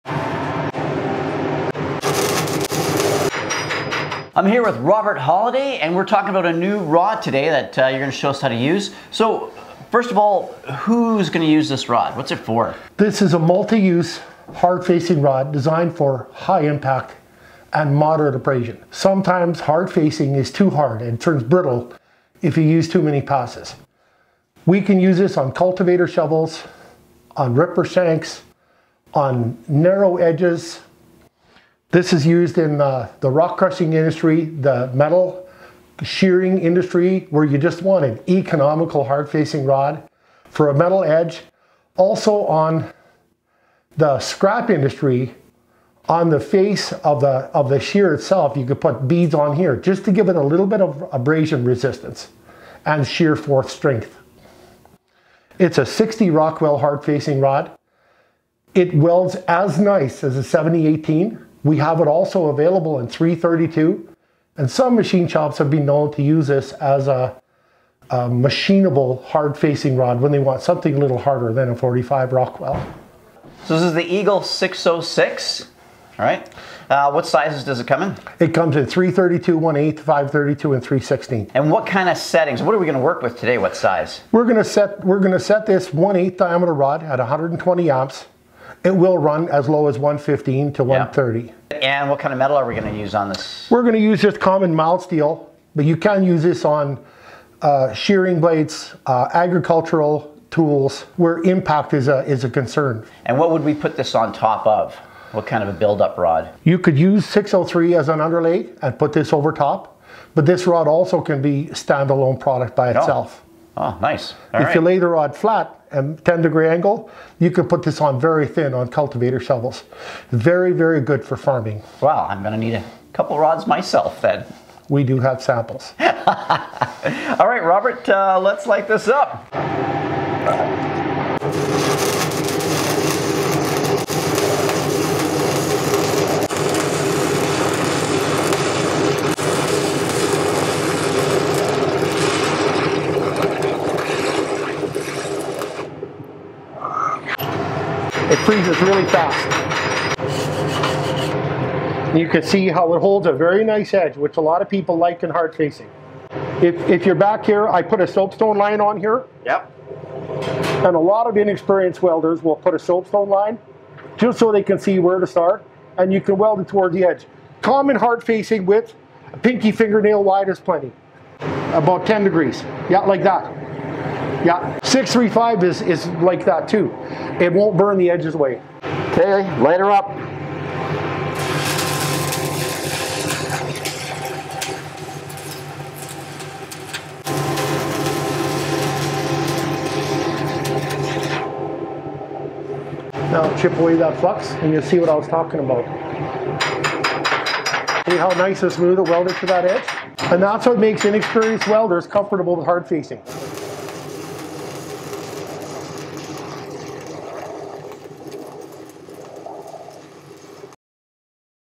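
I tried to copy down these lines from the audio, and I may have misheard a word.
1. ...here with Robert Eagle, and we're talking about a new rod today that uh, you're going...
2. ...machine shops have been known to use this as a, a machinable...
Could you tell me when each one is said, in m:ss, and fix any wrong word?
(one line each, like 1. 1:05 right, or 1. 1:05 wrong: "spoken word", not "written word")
1. 0:04 wrong: "Holiday", not "Eagle"
2. 1:04 right.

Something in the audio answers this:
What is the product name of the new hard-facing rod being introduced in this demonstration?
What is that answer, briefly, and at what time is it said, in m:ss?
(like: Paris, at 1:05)
Eagle 606, at 1:14.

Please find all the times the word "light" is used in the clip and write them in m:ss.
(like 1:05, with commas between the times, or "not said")
2:08, 2:59.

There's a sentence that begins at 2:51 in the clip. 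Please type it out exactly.
About 10 degrees, yeah, like that.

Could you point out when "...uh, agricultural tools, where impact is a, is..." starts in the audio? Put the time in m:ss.
1:39.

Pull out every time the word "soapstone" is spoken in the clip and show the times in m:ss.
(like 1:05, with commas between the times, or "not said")
2:38, 2:42.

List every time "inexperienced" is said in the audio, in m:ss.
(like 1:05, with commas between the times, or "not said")
2:41, 3:21.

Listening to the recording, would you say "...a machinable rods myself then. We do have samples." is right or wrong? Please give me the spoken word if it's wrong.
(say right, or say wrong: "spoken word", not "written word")
wrong: "couple", not "machinable".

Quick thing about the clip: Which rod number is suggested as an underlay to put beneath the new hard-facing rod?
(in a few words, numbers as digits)
603.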